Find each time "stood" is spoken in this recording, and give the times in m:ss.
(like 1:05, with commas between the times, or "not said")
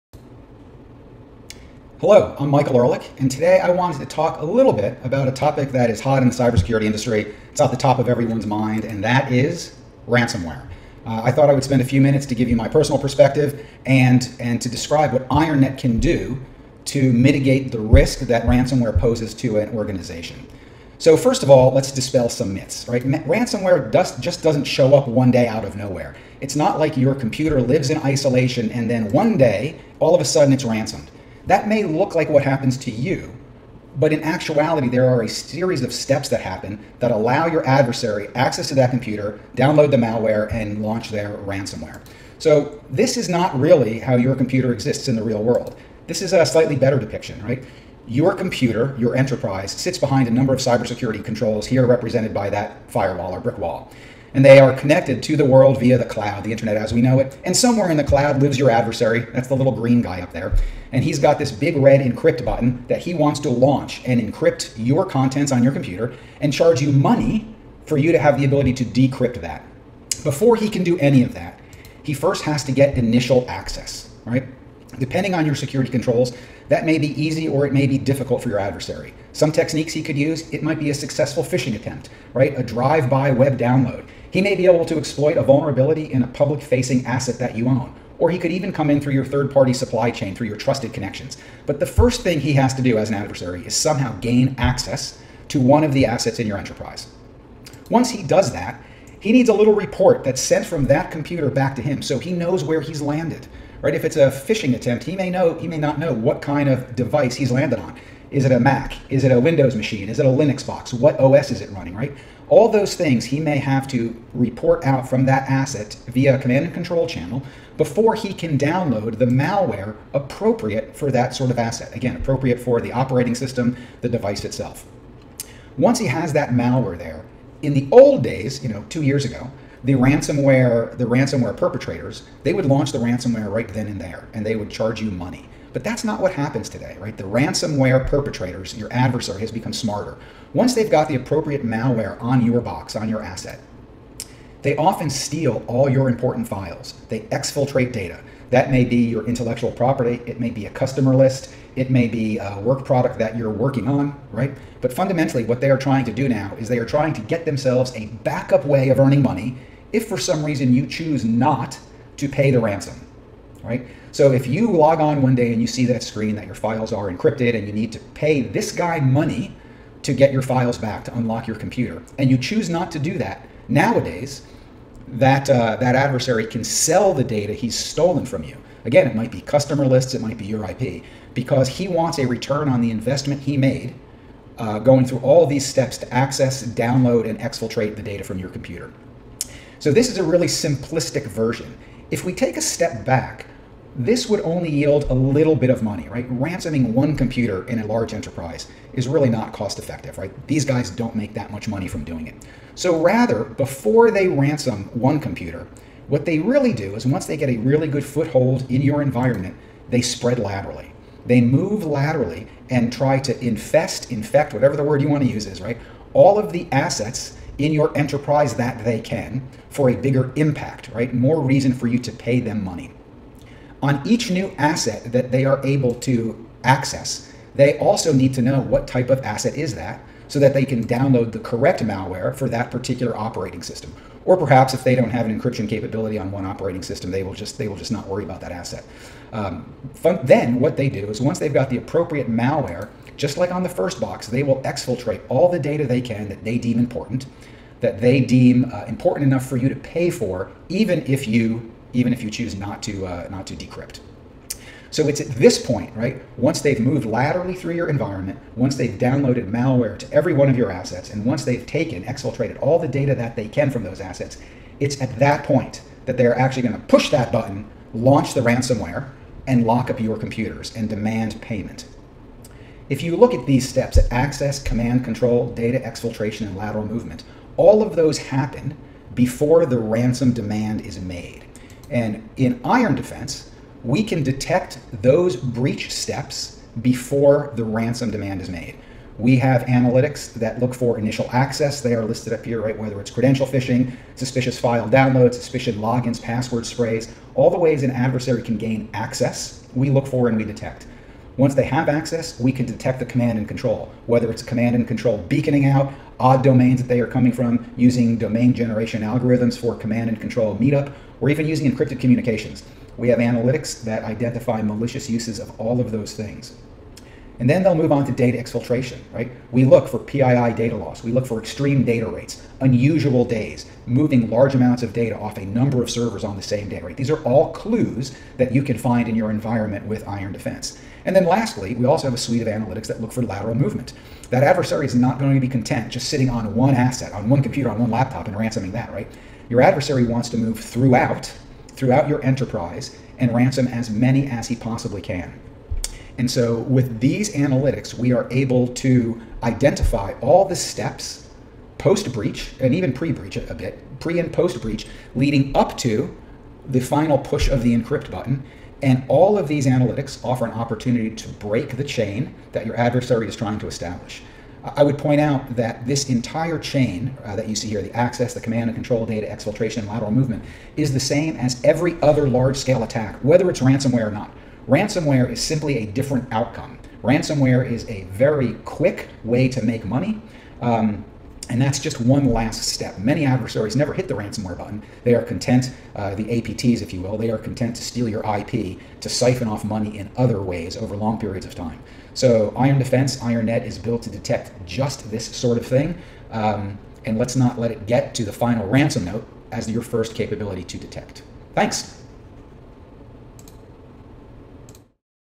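not said.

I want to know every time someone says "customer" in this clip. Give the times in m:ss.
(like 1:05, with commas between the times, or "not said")
2:30, 2:59.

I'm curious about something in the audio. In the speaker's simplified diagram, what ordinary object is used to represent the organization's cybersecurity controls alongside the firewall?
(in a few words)
brick wall.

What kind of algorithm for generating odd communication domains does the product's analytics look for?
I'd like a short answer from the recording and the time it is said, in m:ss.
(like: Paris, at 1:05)
domain generation algorithms, at 5:08.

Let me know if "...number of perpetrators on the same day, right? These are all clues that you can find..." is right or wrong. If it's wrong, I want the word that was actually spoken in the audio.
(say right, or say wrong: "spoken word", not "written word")
wrong: "servers", not "perpetrators".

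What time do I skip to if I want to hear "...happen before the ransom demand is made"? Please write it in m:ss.
4:38.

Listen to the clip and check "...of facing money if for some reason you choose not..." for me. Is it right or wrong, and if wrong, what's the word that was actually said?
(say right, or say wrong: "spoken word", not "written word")
wrong: "earning", not "facing".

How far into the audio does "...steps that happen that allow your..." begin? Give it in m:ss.
0:35.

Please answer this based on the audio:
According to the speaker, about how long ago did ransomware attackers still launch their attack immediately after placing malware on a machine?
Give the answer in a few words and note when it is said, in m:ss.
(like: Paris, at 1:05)
2 years ago, at 2:08.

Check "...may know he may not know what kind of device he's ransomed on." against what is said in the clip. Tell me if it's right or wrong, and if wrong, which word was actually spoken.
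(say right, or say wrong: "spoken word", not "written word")
wrong: "landed", not "ransomed".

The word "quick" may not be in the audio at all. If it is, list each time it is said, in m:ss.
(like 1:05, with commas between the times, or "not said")
6:18.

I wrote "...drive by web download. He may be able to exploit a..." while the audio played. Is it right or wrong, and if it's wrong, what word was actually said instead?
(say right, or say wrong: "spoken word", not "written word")
right.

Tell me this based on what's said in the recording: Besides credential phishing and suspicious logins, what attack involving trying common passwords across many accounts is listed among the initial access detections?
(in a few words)
password sprays.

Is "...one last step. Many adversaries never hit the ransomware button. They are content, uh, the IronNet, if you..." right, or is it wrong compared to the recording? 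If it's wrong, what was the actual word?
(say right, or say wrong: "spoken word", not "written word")
wrong: "APTs", not "IronNet".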